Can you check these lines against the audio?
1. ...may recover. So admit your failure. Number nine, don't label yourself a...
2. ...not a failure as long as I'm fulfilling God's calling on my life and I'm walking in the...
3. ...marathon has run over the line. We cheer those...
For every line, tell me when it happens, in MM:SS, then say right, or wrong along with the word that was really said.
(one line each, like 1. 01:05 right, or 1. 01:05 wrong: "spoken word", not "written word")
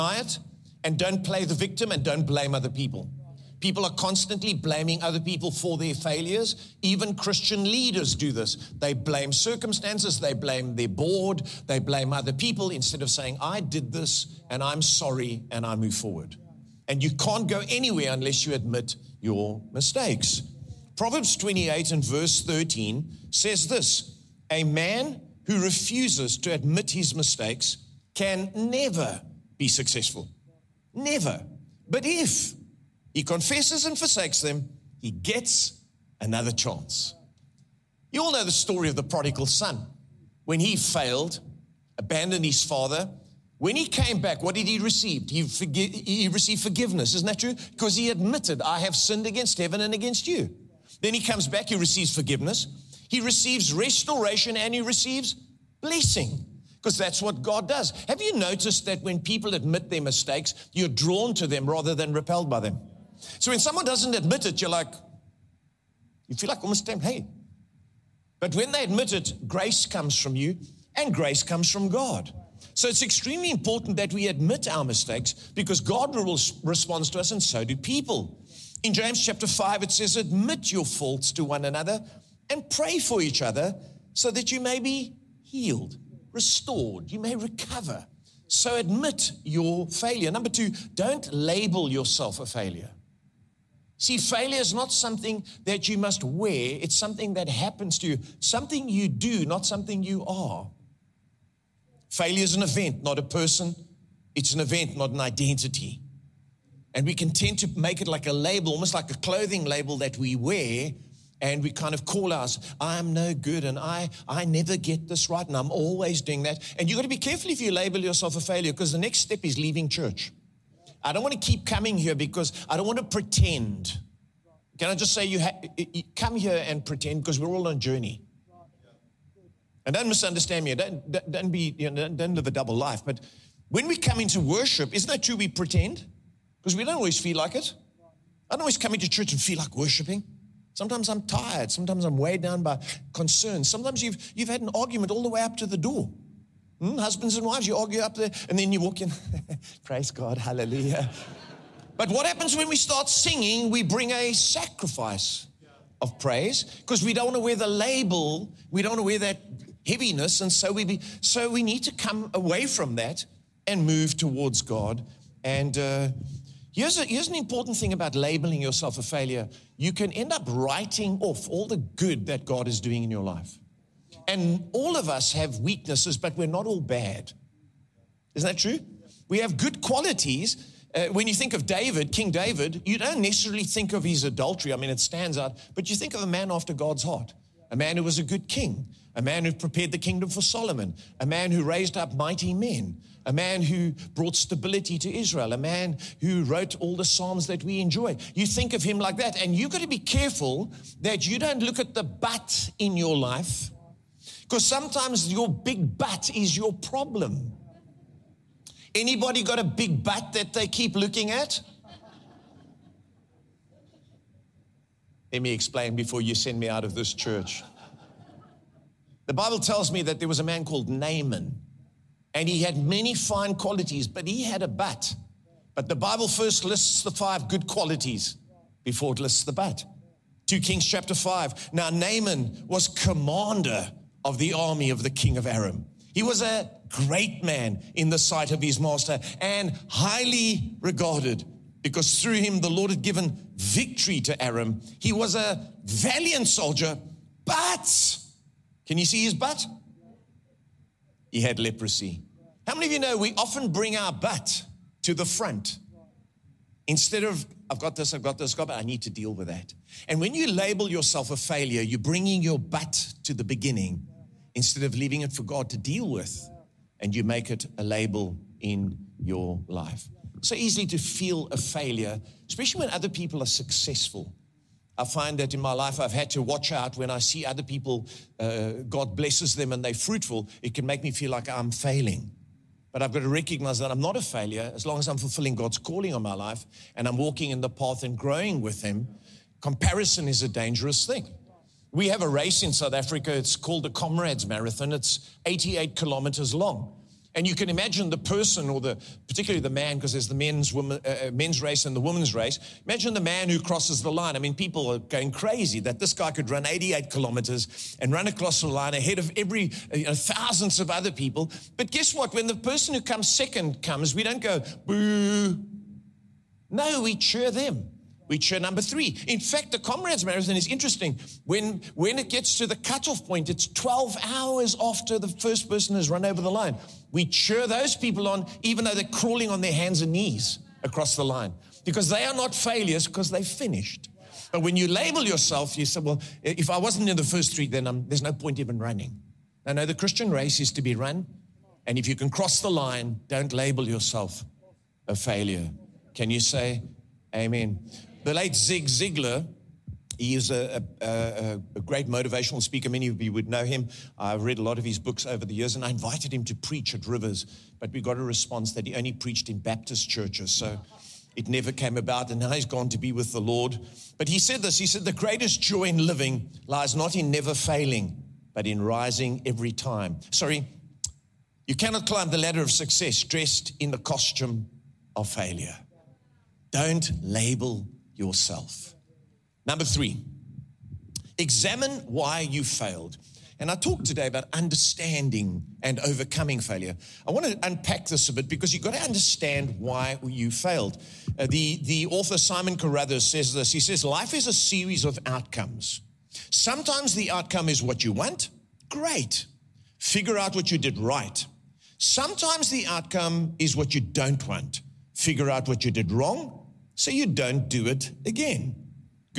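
1. 01:27 wrong: "two", not "nine"
2. 04:44 right
3. 05:25 wrong: "person", not "marathon".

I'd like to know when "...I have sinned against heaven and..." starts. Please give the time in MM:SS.
00:48.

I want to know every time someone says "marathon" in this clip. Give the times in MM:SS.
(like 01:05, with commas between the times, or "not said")
04:54, 05:20.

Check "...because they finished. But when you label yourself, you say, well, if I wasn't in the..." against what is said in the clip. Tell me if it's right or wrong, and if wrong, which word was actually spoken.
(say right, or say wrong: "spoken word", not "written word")
right.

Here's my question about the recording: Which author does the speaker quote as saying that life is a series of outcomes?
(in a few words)
Simon Carruthers.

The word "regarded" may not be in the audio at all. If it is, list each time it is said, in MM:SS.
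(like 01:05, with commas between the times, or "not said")
04:00.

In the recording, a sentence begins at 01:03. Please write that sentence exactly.
So when someone doesn't admit it, you're like, you feel like almost tempted, hey.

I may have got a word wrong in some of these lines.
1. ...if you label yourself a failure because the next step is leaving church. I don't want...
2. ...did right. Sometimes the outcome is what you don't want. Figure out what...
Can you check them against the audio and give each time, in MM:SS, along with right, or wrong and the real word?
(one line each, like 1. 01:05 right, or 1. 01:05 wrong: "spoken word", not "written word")
1. 01:57 right
2. 06:40 right.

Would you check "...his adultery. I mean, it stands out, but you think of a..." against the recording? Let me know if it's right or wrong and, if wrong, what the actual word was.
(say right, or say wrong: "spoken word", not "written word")
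right.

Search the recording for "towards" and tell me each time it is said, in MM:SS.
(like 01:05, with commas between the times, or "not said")
02:44.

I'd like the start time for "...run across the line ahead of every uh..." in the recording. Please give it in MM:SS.
05:08.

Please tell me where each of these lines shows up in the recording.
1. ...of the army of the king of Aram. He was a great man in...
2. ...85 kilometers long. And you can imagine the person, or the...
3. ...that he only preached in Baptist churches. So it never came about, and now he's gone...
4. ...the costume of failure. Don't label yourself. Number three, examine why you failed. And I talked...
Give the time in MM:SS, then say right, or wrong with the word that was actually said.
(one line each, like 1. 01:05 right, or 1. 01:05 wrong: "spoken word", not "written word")
1. 03:54 right
2. 04:55 wrong: "88", not "85"
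3. 05:58 right
4. 06:13 right.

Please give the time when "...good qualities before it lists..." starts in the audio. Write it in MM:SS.
03:47.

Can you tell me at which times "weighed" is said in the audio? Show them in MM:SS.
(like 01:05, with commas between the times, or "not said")
02:22.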